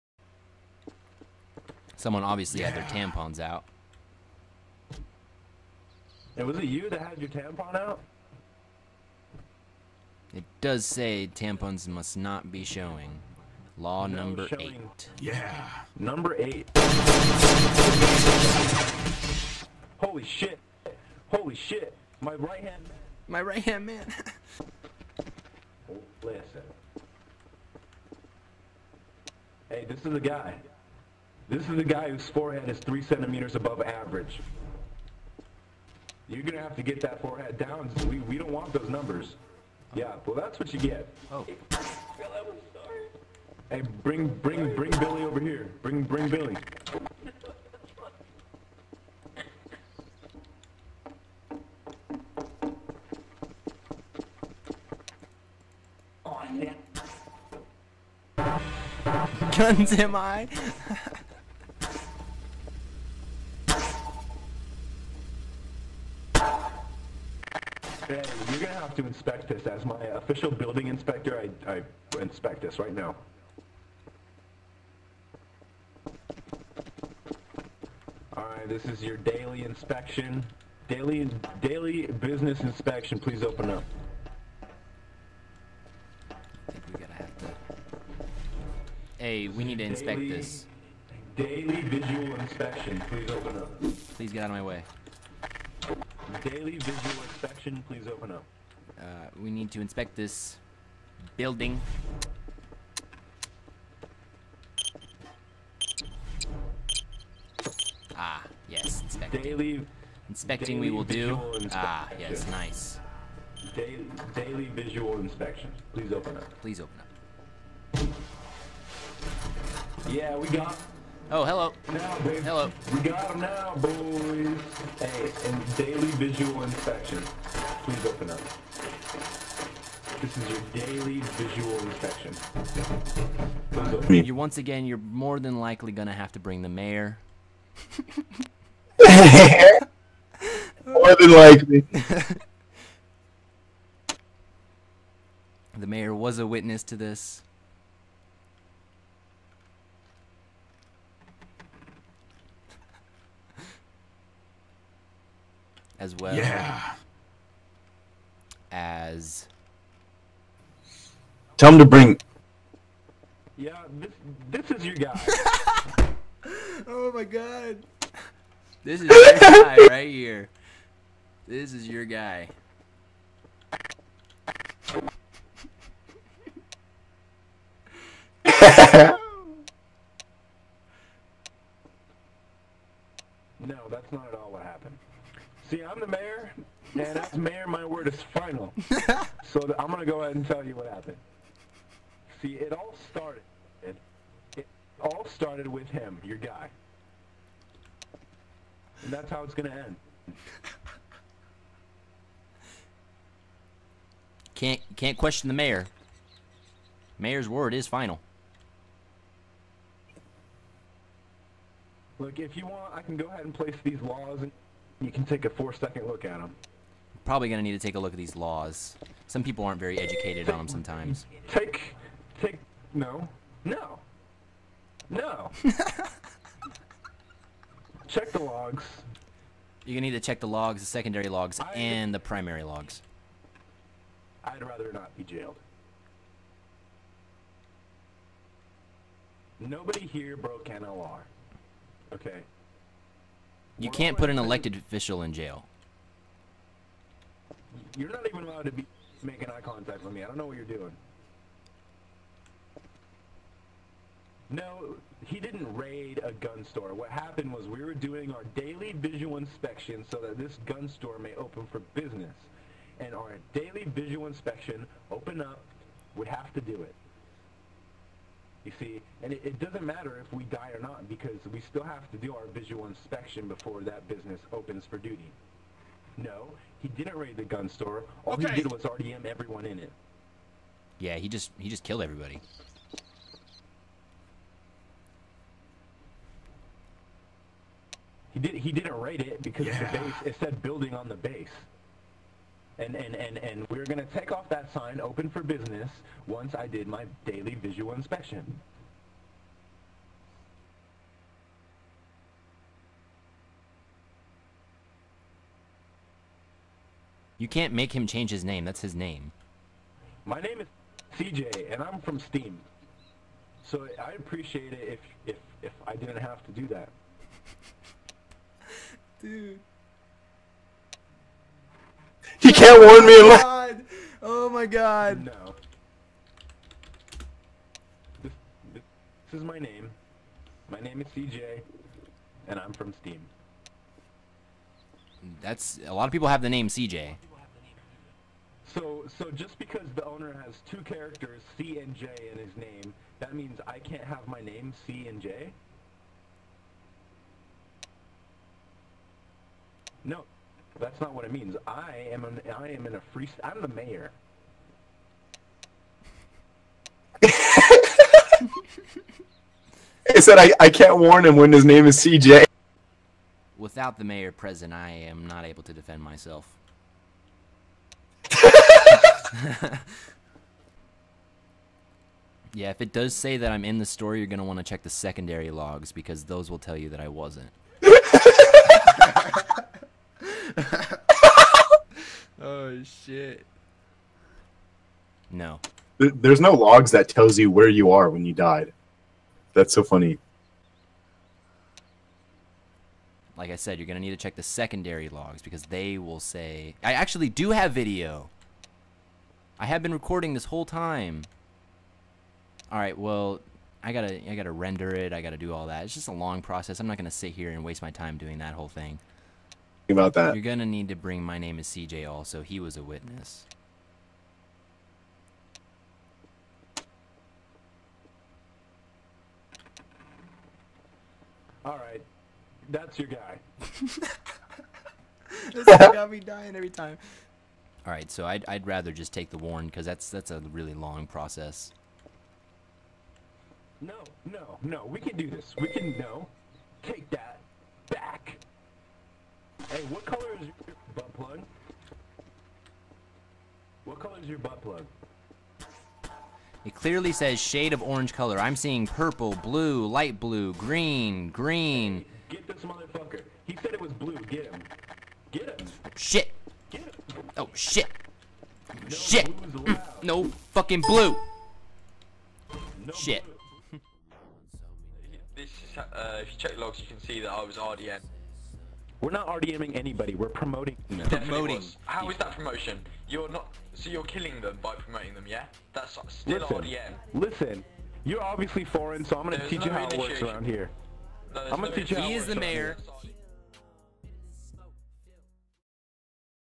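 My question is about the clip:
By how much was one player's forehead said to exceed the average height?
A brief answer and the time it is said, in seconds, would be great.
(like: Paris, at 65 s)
3 centimeters, at 32 s.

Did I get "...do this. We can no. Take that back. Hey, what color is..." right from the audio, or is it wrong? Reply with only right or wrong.
right.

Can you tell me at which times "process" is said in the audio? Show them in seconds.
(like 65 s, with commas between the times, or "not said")
406 s, 431 s.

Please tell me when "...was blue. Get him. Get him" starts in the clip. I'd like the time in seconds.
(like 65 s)
453 s.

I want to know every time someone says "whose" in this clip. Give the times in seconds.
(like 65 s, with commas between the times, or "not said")
32 s.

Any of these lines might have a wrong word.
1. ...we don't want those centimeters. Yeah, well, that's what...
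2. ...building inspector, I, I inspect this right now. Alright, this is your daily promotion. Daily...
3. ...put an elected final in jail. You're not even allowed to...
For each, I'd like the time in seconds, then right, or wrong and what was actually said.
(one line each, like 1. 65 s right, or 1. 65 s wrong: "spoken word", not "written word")
1. 38 s wrong: "numbers", not "centimeters"
2. 70 s wrong: "inspection", not "promotion"
3. 244 s wrong: "official", not "final".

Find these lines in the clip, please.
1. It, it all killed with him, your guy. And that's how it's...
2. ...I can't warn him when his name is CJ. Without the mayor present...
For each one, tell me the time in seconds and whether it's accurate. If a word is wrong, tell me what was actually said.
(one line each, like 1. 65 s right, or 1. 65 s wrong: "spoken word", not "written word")
1. 193 s wrong: "started", not "killed"
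2. 360 s right.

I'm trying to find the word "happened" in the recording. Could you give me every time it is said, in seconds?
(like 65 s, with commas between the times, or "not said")
184 s, 190 s, 257 s.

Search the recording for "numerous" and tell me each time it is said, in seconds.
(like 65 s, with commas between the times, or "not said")
not said.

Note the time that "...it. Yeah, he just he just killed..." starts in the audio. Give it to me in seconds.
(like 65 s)
279 s.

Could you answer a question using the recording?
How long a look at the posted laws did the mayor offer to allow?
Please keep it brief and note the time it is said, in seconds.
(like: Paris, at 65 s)
4 seconds, at 215 s.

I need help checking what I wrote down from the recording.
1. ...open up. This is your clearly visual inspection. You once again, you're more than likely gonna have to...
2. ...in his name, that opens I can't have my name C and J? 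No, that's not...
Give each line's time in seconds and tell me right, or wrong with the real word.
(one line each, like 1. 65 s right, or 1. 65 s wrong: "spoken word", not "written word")
1. 128 s wrong: "daily", not "clearly"
2. 342 s wrong: "means", not "opens".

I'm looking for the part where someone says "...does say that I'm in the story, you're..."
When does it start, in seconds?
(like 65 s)
372 s.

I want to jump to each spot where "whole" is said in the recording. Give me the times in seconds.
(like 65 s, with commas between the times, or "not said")
400 s, 408 s.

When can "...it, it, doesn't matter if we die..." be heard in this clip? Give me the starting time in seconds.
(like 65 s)
269 s.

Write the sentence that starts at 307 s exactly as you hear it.
You can't make him change his name.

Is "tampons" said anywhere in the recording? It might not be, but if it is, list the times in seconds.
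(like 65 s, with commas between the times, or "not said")
2 s, 7 s, 11 s.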